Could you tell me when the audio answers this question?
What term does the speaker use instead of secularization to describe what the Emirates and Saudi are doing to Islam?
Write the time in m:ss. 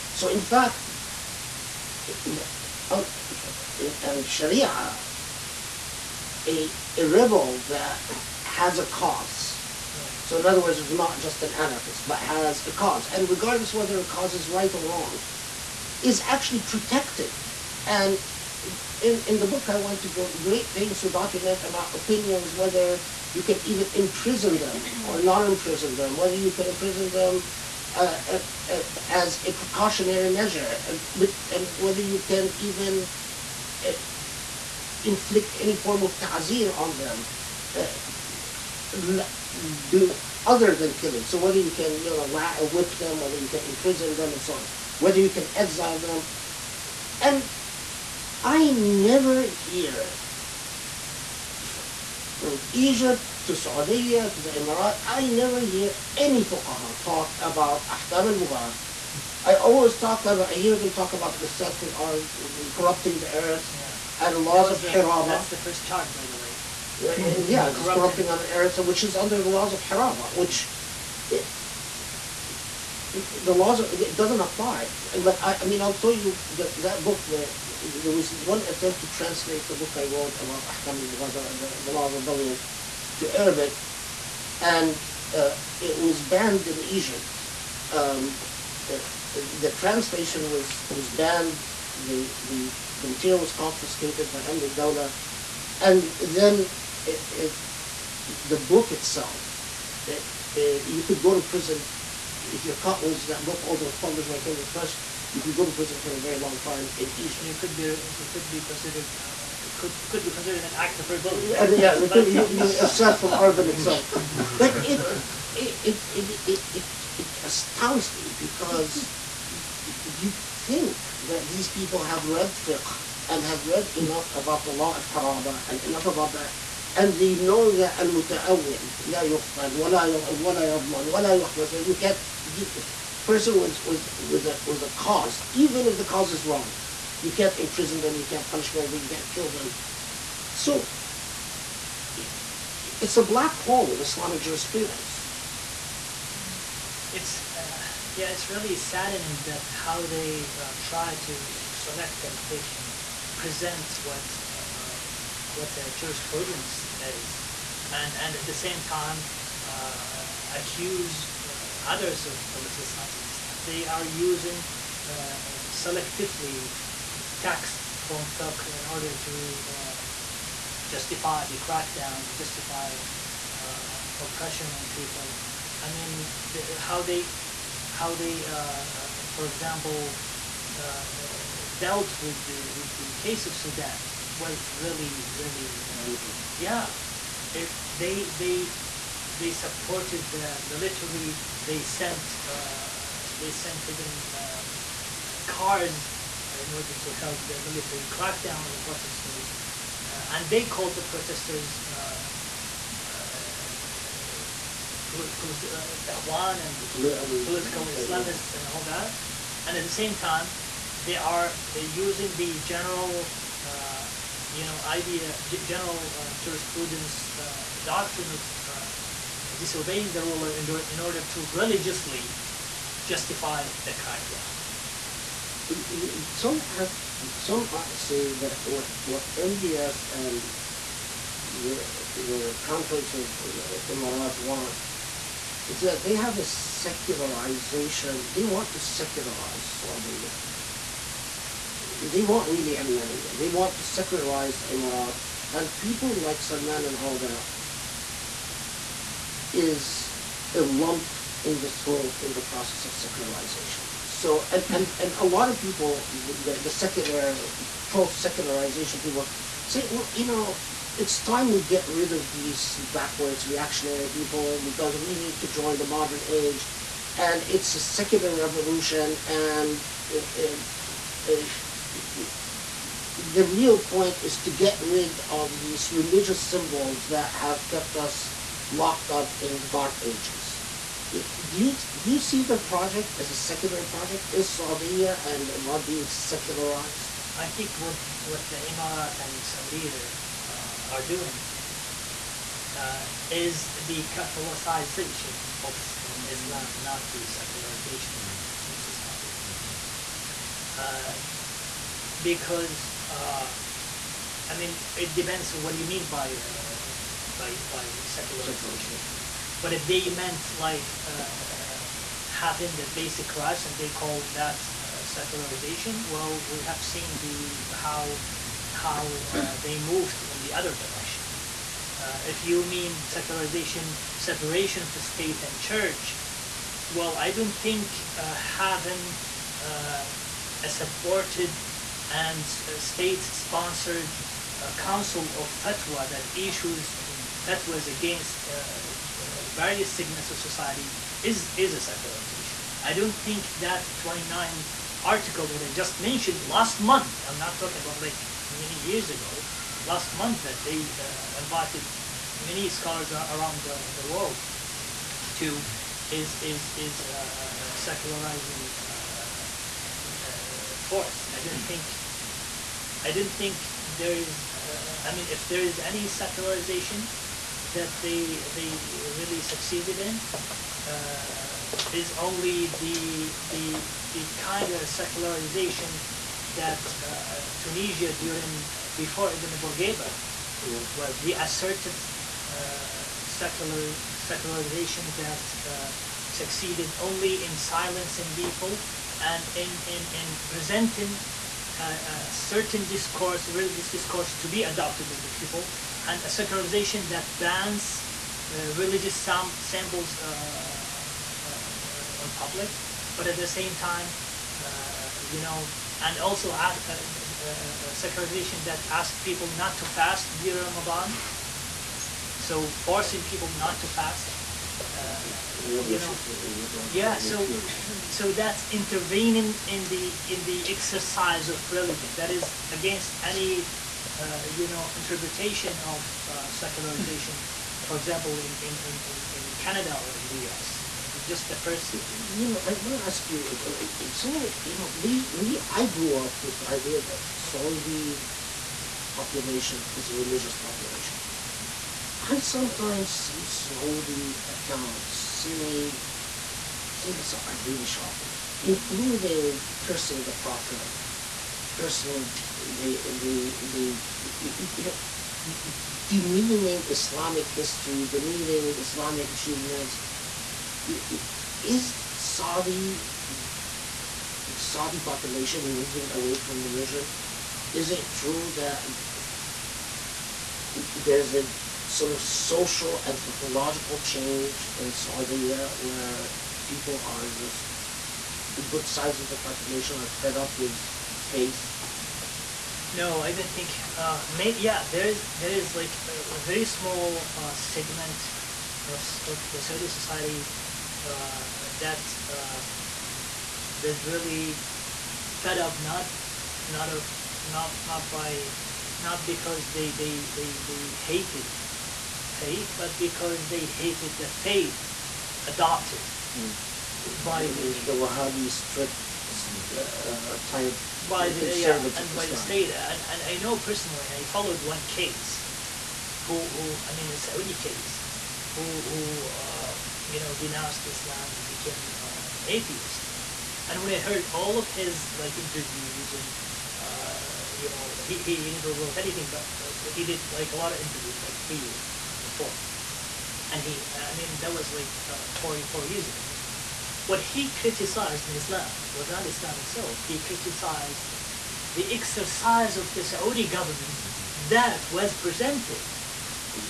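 4:54.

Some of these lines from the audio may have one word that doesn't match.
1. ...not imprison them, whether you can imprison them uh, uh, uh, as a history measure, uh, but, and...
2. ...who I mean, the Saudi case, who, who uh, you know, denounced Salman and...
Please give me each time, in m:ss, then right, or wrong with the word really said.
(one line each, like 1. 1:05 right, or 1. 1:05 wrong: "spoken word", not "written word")
1. 0:25 wrong: "precautionary", not "history"
2. 8:36 wrong: "Islam", not "Salman".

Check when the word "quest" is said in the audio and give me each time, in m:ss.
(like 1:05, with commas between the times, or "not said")
not said.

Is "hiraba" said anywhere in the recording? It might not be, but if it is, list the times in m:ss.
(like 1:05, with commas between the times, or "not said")
1:04, 1:09.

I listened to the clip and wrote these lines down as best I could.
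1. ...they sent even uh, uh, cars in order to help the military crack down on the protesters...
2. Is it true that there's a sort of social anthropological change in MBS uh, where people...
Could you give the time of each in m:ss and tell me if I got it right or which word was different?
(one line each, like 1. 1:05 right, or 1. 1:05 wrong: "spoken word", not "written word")
1. 3:13 right
2. 7:47 wrong: "Saudi", not "MBS".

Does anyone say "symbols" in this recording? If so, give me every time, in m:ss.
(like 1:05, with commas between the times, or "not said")
4:36, 6:39.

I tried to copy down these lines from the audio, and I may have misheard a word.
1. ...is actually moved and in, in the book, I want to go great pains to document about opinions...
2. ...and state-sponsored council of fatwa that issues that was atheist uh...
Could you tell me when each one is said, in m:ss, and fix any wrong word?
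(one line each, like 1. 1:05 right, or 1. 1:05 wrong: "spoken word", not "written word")
1. 0:16 wrong: "protected", not "moved"
2. 5:32 wrong: "against", not "atheist".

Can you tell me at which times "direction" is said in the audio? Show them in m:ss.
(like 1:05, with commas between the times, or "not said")
5:20.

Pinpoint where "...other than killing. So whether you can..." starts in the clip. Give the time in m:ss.
0:40.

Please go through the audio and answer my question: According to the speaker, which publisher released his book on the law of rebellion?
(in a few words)
Cambridge Press.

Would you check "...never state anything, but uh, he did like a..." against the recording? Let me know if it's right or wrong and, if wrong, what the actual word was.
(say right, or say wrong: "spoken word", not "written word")
wrong: "wrote", not "state".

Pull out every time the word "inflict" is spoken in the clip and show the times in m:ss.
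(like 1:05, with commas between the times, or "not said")
0:35.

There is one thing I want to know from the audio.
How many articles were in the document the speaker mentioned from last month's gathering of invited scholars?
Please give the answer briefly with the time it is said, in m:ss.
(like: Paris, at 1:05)
29, at 5:43.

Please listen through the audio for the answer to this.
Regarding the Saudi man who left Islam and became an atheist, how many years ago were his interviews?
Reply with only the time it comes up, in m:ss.
8:55.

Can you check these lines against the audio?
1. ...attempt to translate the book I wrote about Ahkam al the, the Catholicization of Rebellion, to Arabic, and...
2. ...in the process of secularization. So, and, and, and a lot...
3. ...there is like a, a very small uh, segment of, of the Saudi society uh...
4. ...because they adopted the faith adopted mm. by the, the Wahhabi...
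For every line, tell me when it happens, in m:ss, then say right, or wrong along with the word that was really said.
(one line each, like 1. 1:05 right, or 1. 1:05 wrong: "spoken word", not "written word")
1. 1:18 wrong: "Law", not "Catholicization"
2. 4:12 right
3. 8:05 right
4. 8:22 wrong: "hated", not "adopted".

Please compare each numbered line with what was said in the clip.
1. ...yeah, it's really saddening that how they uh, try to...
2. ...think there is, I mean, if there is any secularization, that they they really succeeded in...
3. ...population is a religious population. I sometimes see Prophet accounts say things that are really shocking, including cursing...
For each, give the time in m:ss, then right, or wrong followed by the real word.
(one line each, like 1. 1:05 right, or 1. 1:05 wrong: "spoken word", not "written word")
1. 2:28 right
2. 6:03 right
3. 7:19 wrong: "Saudi", not "Prophet".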